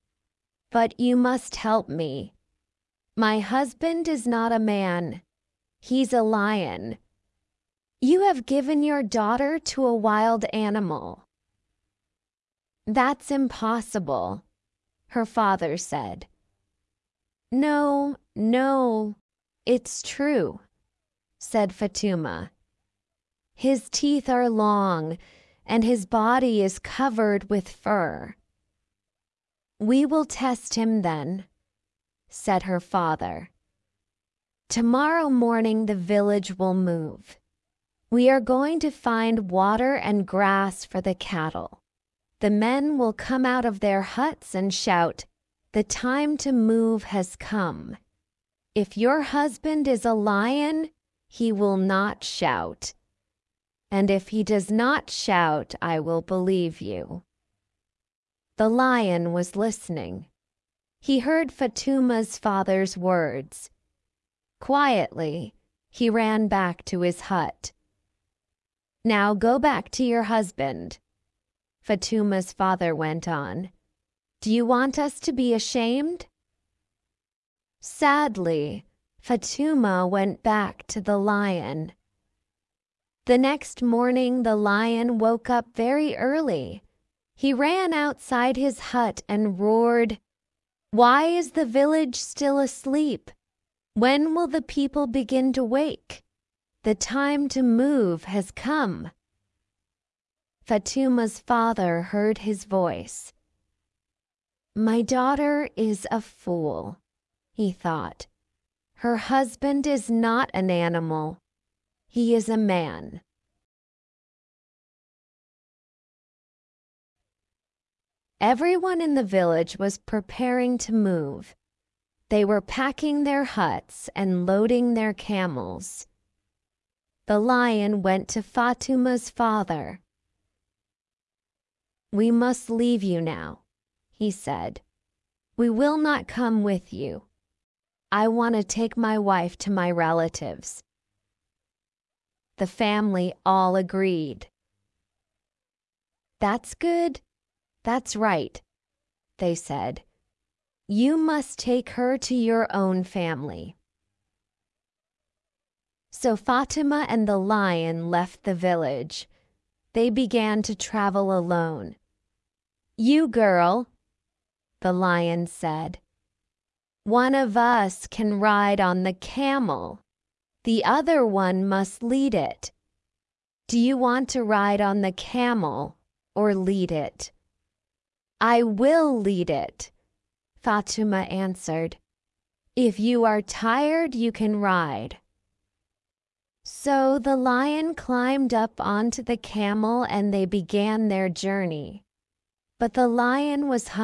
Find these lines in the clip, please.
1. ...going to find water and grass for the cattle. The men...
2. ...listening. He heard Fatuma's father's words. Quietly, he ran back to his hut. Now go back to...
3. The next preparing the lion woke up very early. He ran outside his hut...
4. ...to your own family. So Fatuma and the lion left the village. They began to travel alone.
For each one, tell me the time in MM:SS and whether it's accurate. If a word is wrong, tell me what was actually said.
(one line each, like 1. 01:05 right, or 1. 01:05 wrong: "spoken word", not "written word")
1. 00:38 right
2. 00:59 right
3. 01:23 wrong: "morning", not "preparing"
4. 02:32 right.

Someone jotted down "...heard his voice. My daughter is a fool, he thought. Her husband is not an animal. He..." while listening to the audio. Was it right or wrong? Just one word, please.
right.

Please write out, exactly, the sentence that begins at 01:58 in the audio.
Everyone in the village was preparing to move.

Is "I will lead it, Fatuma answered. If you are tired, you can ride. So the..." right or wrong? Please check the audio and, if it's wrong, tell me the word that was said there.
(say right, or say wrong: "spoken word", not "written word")
right.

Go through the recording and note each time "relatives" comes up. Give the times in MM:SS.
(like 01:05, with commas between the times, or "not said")
02:19.